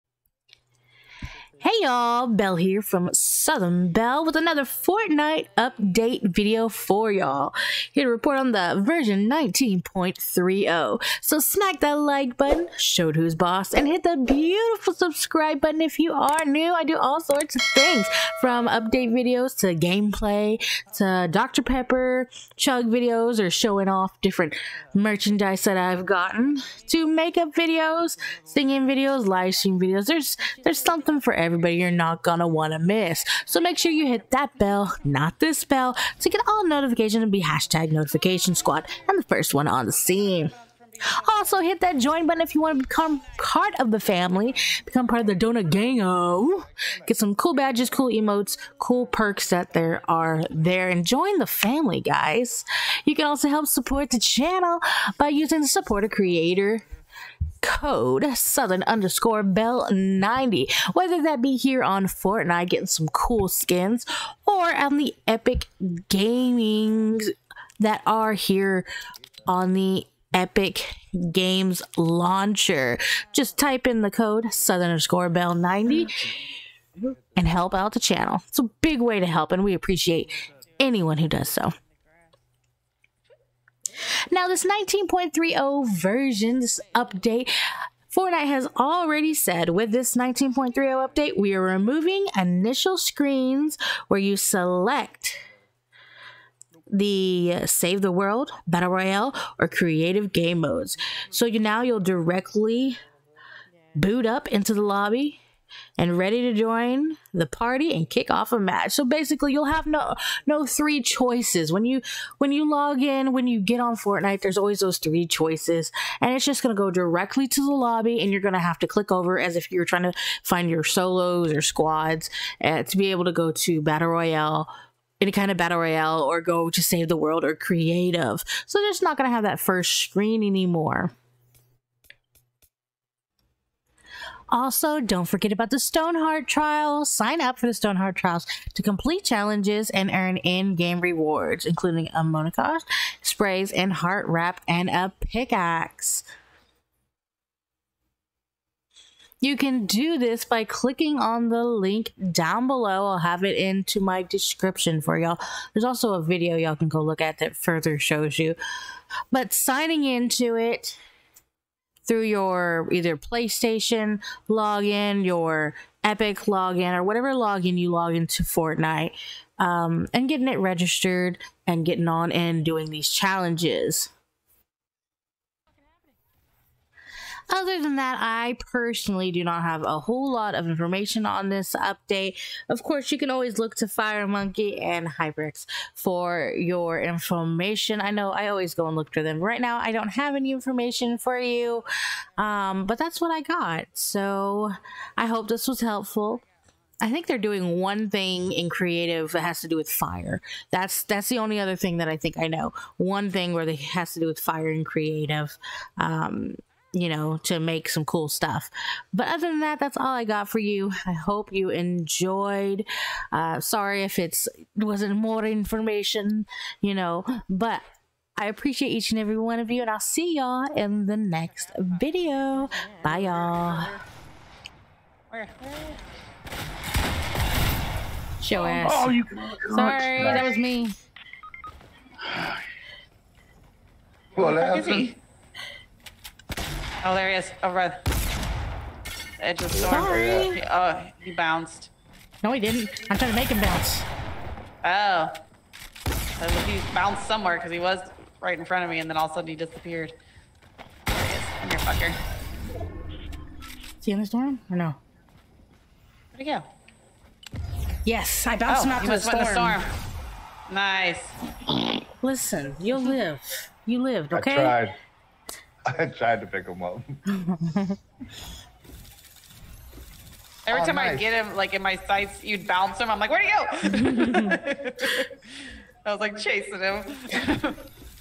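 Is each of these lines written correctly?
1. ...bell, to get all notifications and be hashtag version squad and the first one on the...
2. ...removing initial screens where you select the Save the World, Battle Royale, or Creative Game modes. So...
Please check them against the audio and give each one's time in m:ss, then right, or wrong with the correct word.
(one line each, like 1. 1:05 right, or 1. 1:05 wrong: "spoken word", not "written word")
1. 0:35 wrong: "notification", not "version"
2. 1:31 right.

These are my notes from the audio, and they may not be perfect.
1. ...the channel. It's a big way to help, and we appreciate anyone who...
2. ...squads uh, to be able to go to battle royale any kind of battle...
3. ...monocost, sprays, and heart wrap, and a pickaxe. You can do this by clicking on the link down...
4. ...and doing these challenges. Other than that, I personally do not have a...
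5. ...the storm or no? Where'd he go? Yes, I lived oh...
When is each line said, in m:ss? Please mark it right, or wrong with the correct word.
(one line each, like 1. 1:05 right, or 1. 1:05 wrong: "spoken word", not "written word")
1. 1:17 right
2. 2:01 right
3. 2:22 right
4. 2:52 right
5. 4:14 wrong: "bounced", not "lived".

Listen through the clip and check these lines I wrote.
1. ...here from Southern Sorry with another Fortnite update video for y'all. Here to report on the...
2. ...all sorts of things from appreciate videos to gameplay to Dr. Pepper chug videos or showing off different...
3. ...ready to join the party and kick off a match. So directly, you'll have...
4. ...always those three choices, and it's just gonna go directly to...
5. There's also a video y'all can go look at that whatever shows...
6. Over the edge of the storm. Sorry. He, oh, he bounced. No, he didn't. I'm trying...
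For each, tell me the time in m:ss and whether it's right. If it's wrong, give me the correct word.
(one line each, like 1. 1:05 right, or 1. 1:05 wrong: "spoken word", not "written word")
1. 0:02 wrong: "Bell", not "Sorry"
2. 0:16 wrong: "update", not "appreciate"
3. 1:46 wrong: "basically", not "directly"
4. 1:54 right
5. 2:35 wrong: "further", not "whatever"
6. 3:57 right.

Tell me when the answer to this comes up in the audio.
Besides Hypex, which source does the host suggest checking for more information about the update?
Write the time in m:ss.
3:03.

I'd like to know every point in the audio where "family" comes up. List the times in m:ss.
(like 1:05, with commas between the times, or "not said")
0:43, 0:51.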